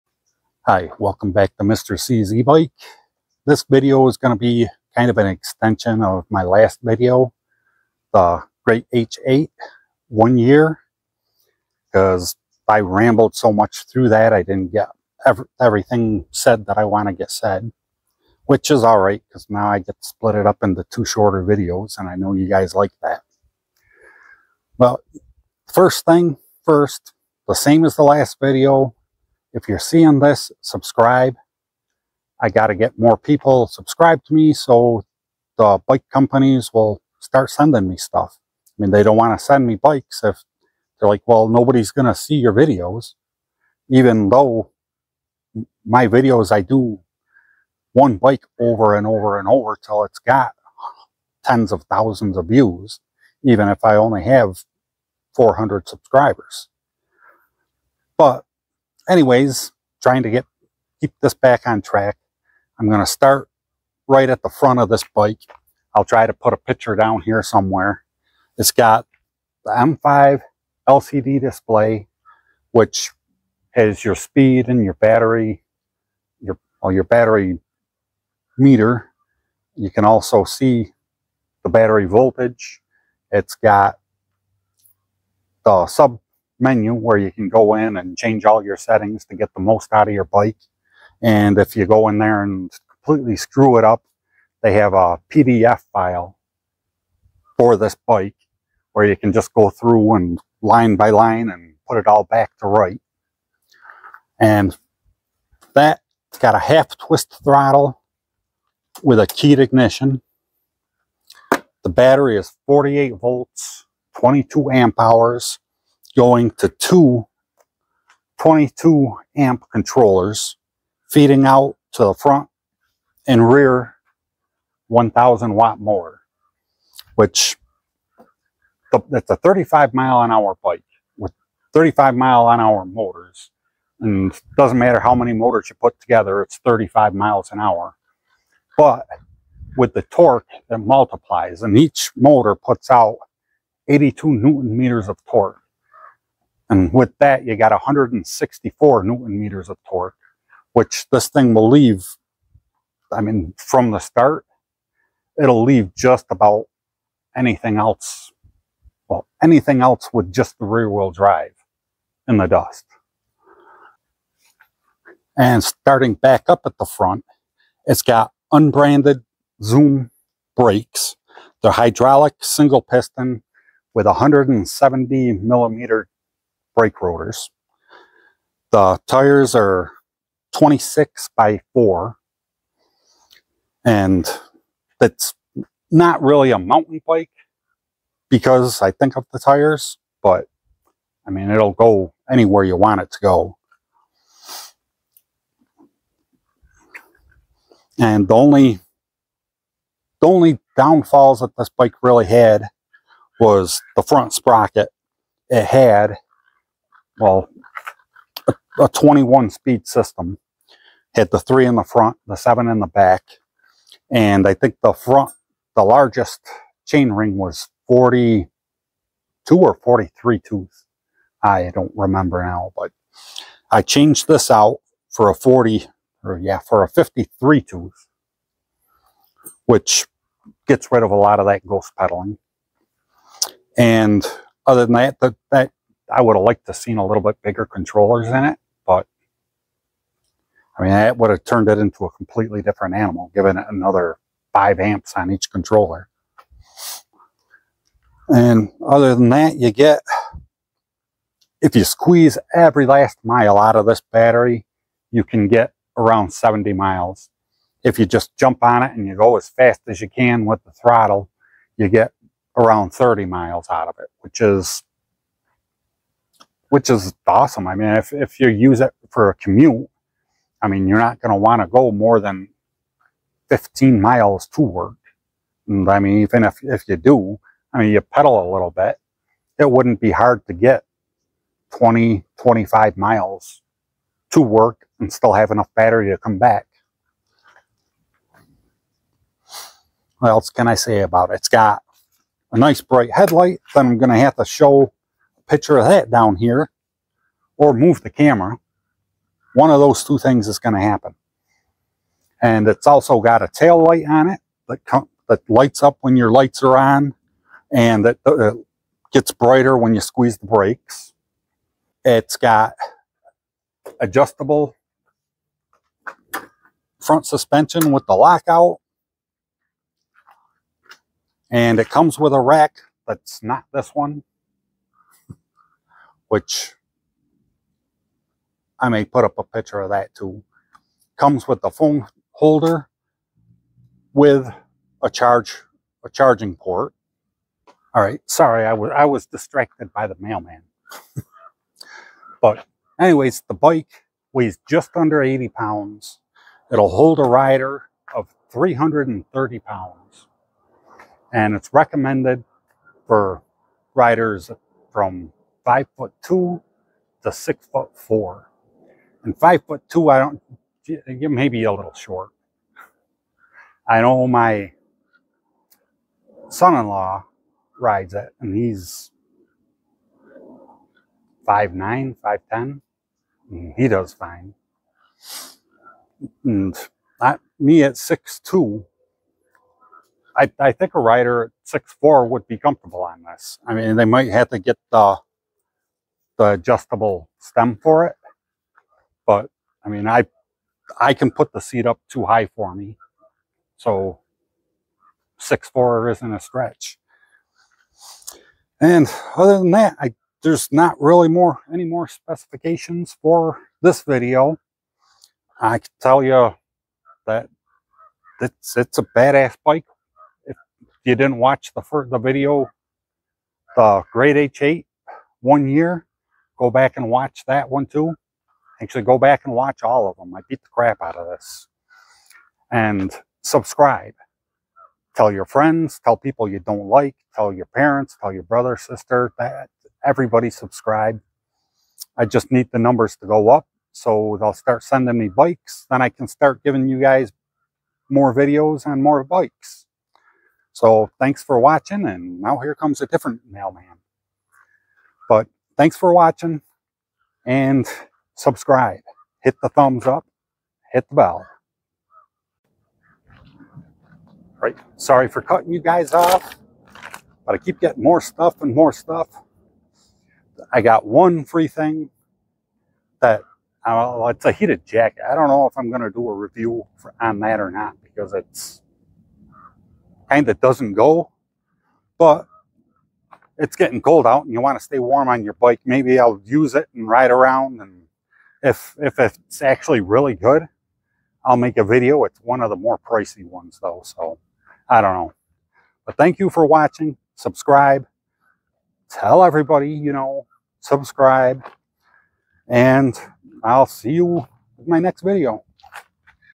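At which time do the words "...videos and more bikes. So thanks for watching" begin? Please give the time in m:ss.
7:18.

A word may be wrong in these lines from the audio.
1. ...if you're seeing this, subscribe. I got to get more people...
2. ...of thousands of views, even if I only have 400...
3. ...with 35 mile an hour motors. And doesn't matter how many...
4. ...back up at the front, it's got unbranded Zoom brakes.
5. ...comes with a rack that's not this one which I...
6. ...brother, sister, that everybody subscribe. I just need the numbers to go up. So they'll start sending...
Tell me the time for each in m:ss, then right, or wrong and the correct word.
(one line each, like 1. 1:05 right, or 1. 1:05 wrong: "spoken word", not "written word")
1. 0:29 right
2. 0:51 right
3. 2:11 right
4. 2:46 right
5. 5:21 right
6. 7:08 right.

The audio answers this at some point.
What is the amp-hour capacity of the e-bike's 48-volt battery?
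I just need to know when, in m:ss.
1:54.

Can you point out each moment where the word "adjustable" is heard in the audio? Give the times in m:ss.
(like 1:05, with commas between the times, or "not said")
5:13, 6:26.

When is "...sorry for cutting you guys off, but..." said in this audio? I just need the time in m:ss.
7:34.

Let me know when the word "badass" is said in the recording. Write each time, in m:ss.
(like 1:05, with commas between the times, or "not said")
6:49.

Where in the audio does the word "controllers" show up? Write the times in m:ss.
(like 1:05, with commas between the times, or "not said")
1:59, 3:57, 4:05.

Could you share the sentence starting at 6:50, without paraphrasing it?
If you didn't watch the first, the video, the Great H8 one year, Go back and watch that one too.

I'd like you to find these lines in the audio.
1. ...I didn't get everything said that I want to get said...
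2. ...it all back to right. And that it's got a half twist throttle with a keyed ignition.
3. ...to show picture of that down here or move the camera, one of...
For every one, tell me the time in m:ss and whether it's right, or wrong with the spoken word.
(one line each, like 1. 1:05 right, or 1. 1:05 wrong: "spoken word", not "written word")
1. 0:14 right
2. 1:41 right
3. 4:54 right.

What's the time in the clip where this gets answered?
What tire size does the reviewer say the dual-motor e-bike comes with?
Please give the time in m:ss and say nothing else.
3:00.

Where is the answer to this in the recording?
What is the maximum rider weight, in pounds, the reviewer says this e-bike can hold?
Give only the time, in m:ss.
5:48.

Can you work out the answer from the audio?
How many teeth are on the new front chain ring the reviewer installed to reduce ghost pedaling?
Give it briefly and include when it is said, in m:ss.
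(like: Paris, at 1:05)
53, at 3:46.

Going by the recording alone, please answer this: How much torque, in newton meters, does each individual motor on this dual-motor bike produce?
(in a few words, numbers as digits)
82.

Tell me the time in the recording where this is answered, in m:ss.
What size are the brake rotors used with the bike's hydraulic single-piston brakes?
2:54.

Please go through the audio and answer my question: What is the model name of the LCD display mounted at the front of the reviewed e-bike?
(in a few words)
M5.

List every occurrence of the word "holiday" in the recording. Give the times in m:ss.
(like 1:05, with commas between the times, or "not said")
not said.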